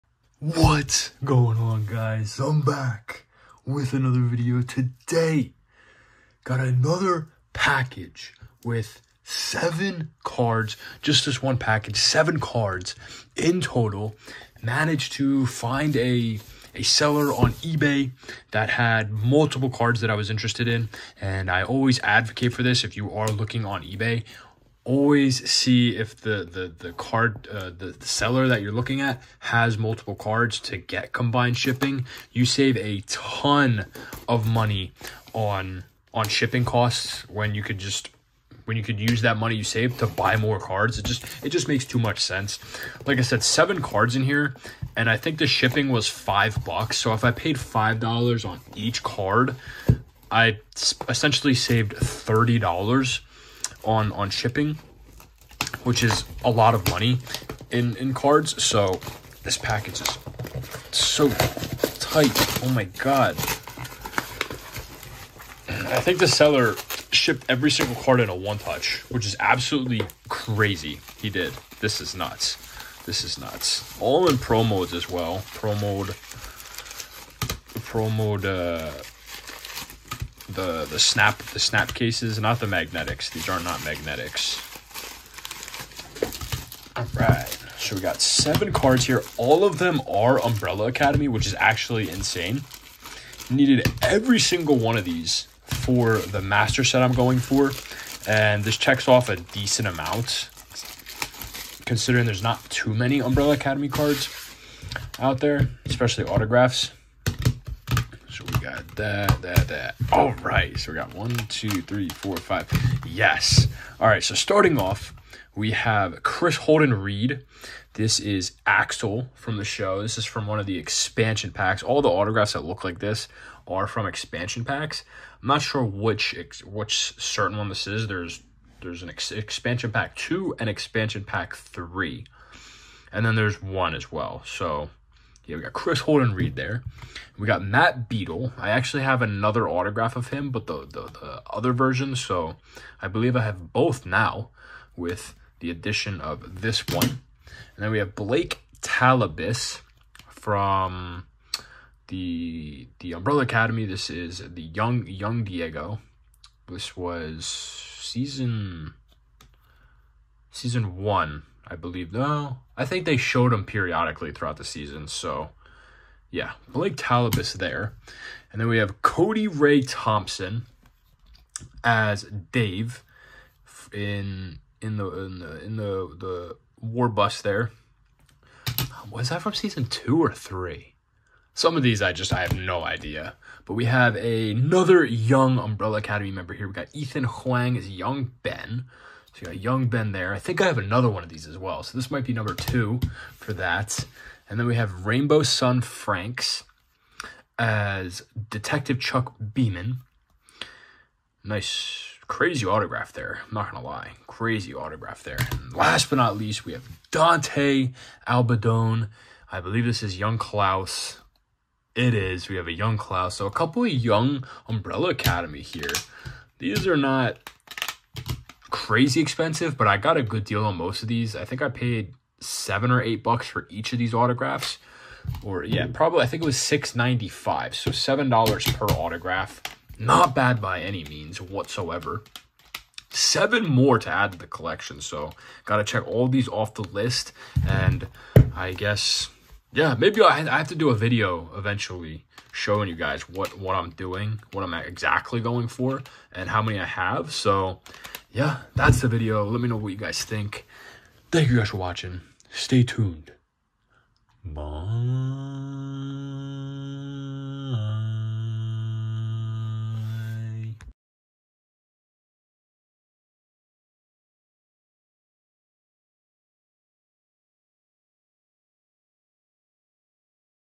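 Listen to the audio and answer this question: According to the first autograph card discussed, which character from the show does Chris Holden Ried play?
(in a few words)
Axel.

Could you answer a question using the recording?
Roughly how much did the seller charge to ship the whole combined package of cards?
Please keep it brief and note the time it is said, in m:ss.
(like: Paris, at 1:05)
$5, at 0:46.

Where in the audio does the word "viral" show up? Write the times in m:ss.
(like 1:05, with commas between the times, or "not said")
not said.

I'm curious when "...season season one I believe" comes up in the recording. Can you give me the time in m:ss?
2:37.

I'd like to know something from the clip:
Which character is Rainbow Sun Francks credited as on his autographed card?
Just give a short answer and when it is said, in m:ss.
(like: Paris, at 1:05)
Detective Chuck Beaman, at 3:18.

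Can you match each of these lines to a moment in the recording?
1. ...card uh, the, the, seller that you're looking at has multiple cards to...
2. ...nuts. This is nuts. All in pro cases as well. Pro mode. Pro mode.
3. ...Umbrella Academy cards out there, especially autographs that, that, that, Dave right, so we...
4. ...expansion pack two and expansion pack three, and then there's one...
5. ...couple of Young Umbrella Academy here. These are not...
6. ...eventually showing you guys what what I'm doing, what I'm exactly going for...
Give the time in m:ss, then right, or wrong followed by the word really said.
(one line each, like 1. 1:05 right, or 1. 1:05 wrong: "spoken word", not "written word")
1. 0:26 right
2. 1:12 wrong: "modes", not "cases"
3. 1:43 wrong: "All", not "Dave"
4. 2:09 right
5. 3:33 right
6. 4:01 right.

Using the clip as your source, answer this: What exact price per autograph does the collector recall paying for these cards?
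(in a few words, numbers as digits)
$6.95.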